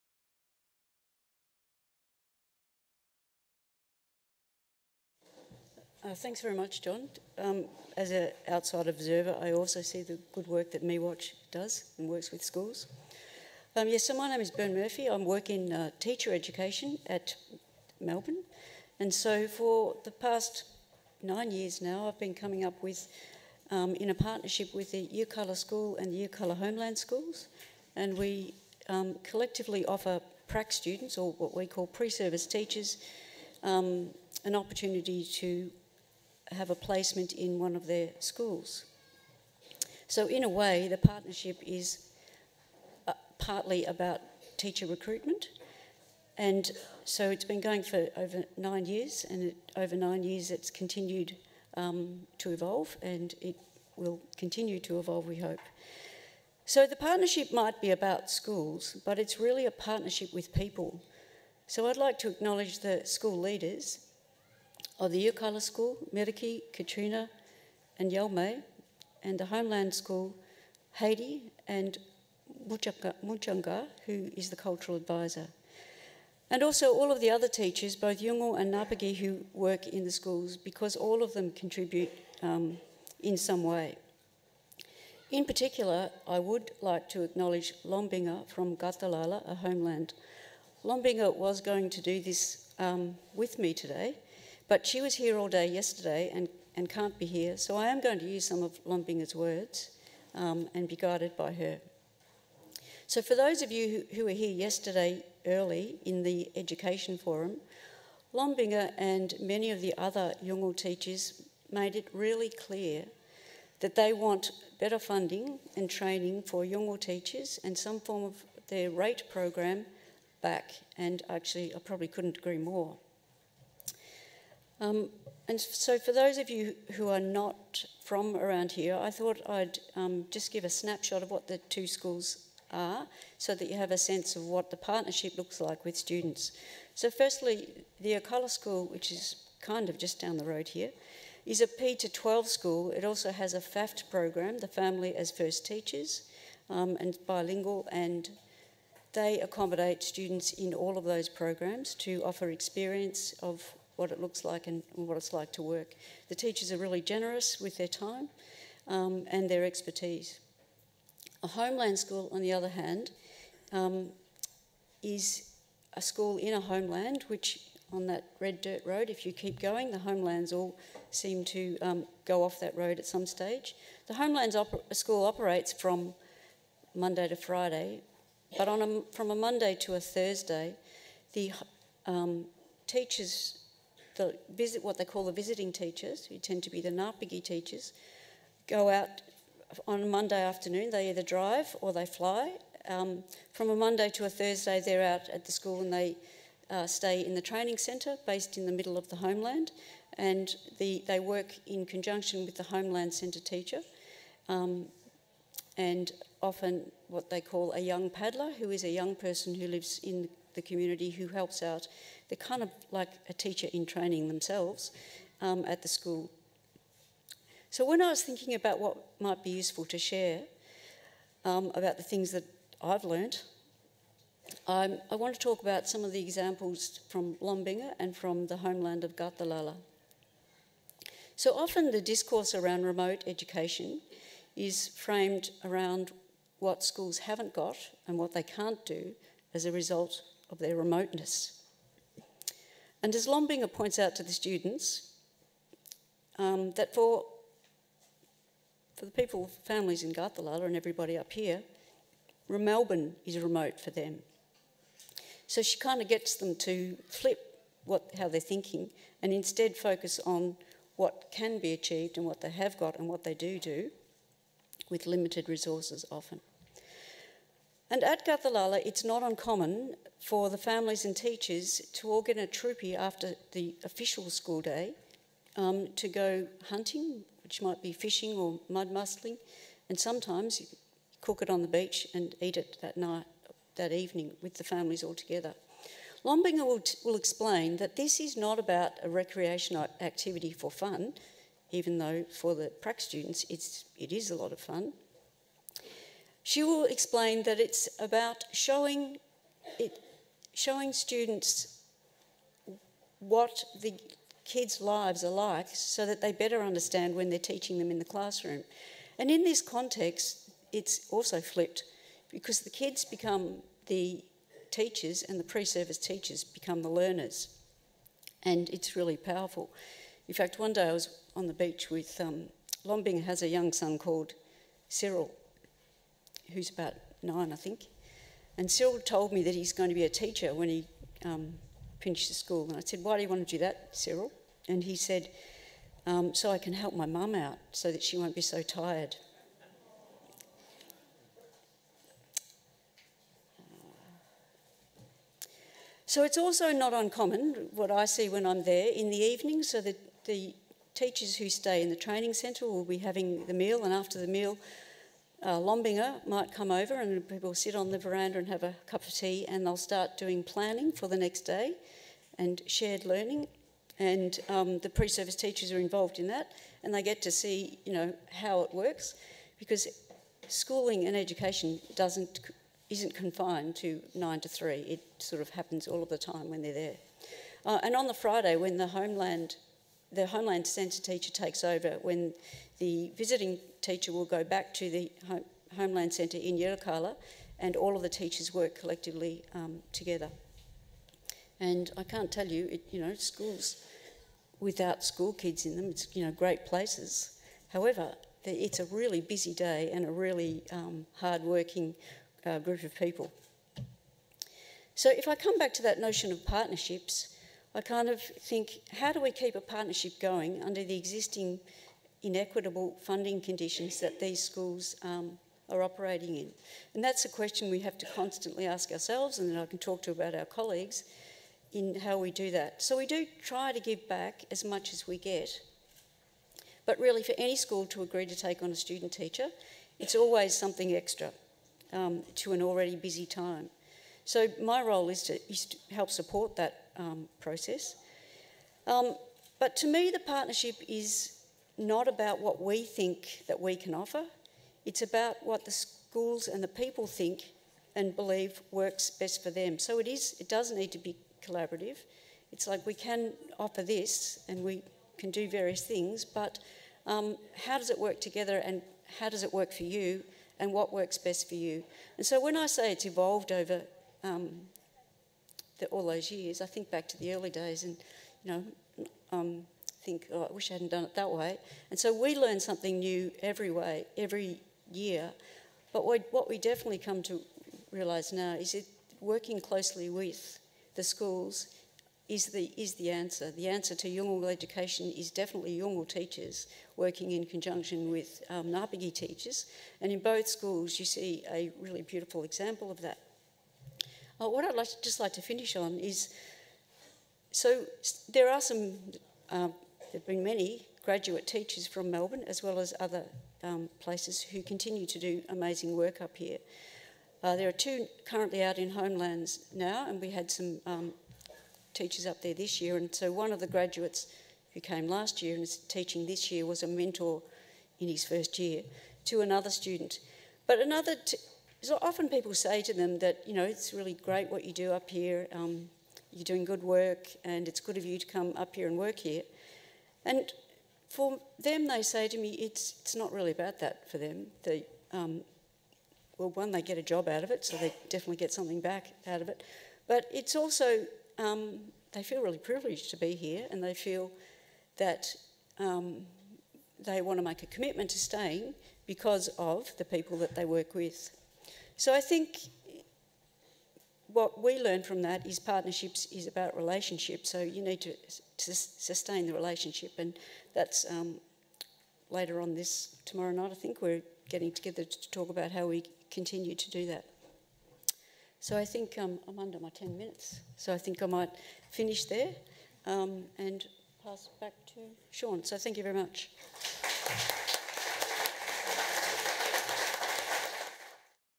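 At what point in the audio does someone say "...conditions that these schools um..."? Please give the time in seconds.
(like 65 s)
413 s.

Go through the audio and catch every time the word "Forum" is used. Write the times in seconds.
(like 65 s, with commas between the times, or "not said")
107 s.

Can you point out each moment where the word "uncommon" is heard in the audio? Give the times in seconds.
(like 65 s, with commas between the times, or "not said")
269 s, 346 s.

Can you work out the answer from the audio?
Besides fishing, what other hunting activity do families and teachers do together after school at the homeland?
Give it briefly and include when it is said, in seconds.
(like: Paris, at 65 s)
mud mussling, at 278 s.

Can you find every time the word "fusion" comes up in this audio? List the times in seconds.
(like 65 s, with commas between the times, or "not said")
not said.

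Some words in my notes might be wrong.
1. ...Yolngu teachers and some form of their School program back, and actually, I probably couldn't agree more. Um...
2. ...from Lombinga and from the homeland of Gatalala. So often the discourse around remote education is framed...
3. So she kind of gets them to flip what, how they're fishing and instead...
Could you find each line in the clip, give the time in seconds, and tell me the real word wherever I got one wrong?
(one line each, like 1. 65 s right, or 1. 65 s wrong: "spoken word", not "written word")
1. 116 s wrong: "RATE", not "School"
2. 227 s right
3. 255 s wrong: "thinking", not "fishing".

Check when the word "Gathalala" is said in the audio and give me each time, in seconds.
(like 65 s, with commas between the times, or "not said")
250 s, 268 s.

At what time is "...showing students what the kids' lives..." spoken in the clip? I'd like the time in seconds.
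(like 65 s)
300 s.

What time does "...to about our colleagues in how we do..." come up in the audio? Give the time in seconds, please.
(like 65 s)
420 s.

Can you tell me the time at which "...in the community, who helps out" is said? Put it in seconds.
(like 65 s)
210 s.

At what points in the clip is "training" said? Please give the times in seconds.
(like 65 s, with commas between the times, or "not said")
115 s, 197 s, 213 s, 351 s.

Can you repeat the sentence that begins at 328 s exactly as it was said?
And Cyril told me that he's going to be a teacher when he um, finishes school.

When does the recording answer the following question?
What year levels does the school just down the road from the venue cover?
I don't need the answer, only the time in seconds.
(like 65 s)
141 s.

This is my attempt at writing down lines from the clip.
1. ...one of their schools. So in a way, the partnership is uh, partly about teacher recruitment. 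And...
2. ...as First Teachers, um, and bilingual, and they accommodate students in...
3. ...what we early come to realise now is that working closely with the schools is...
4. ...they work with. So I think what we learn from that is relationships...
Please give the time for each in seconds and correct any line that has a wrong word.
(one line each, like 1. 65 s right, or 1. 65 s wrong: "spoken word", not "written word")
1. 37 s right
2. 145 s right
3. 476 s wrong: "definitely", not "early"
4. 550 s wrong: "partnerships", not "relationships".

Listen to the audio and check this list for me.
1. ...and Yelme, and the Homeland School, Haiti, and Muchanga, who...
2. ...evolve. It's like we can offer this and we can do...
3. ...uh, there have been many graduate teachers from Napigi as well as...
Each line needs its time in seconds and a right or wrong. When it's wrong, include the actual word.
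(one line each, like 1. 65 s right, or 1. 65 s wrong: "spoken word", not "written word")
1. 67 s right
2. 451 s wrong: "collaborative", not "evolve"
3. 499 s wrong: "Melbourne", not "Napigi".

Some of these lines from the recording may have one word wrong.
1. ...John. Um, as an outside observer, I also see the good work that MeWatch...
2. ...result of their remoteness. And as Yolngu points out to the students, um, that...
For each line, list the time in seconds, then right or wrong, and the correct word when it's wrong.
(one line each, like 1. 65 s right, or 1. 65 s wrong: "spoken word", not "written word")
1. 6 s right
2. 239 s wrong: "Lombinger", not "Yolngu".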